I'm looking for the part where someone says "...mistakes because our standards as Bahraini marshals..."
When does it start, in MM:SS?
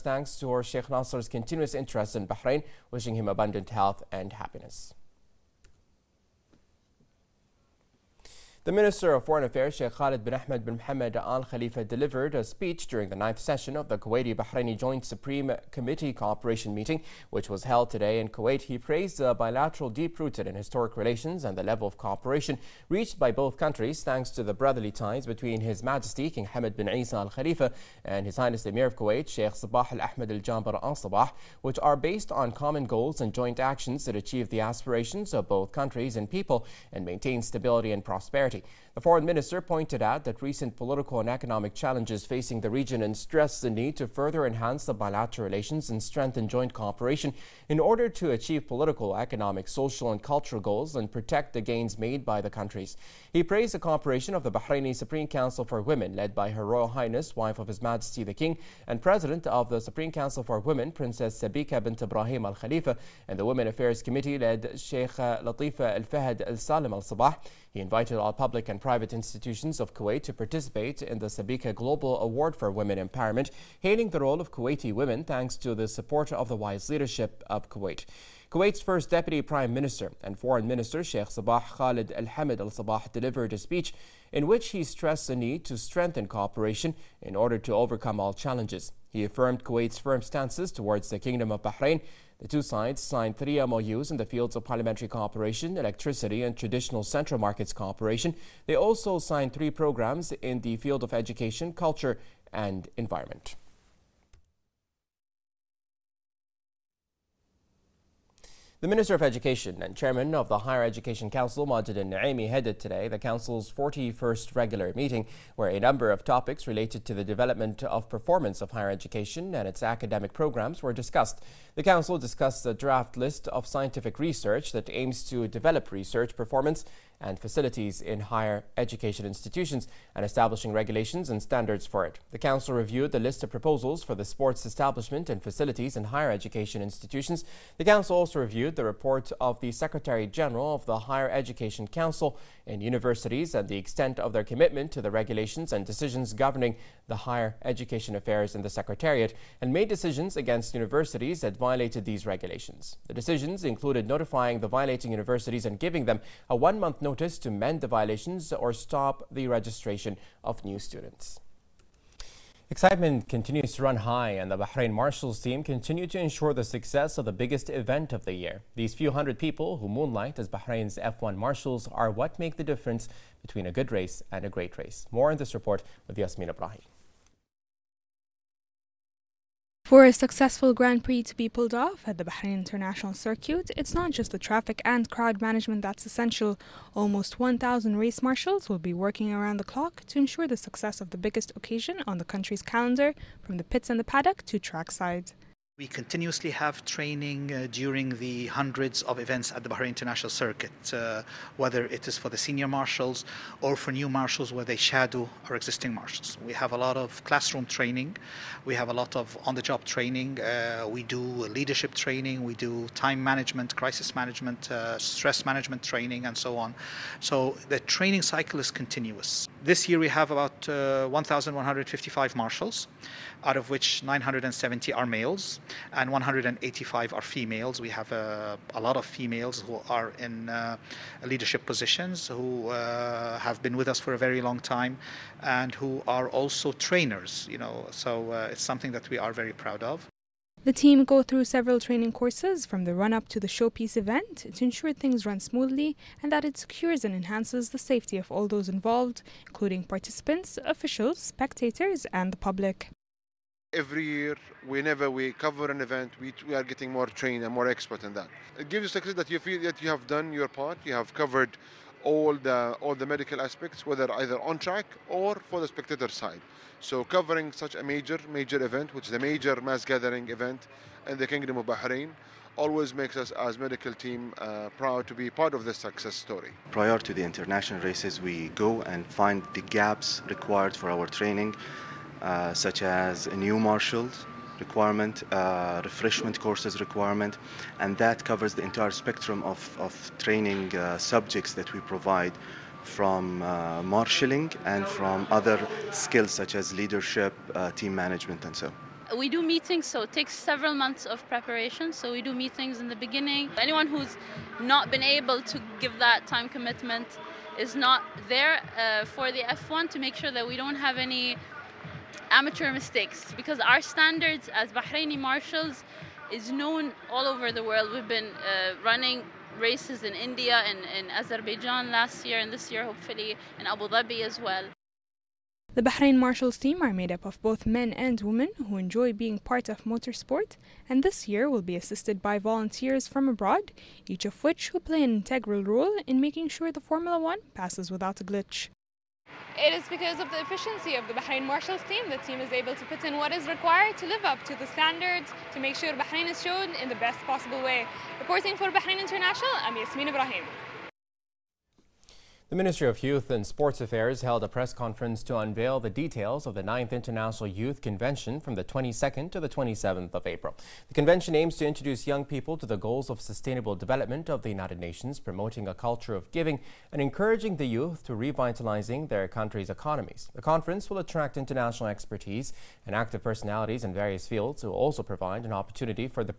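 05:12.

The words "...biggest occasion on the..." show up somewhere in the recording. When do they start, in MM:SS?
03:11.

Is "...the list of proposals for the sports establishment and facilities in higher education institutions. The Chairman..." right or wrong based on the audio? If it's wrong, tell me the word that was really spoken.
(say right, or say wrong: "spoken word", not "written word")
wrong: "Council", not "Chairman".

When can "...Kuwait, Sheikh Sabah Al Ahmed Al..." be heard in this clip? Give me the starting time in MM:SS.
00:28.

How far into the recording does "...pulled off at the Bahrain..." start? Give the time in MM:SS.
03:01.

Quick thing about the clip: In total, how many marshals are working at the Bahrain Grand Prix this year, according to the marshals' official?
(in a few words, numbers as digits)
1,155.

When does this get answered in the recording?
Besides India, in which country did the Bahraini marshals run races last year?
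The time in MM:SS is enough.
05:21.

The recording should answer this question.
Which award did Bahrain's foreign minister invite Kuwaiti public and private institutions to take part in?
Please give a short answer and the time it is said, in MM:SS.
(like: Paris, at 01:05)
Sabika Global Award for Women Empowerment, at 01:11.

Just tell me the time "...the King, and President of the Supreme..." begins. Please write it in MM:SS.
00:58.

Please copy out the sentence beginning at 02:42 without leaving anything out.
Excitement continues to run high, and the Bahrain Marshals team continue to ensure the success of the biggest event of the year.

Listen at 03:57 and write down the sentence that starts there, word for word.
You know, so uh, it's something that we are very proud of.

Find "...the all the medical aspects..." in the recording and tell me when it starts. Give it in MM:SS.
04:22.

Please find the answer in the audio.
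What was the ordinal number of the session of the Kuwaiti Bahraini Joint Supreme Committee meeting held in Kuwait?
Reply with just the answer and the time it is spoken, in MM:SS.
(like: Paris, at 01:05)
ninth, at 00:13.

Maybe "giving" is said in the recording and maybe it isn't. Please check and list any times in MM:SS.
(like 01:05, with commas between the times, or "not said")
02:35, 06:06.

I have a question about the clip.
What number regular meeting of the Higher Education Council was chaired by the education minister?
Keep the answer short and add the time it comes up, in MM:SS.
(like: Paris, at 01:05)
41st, at 01:53.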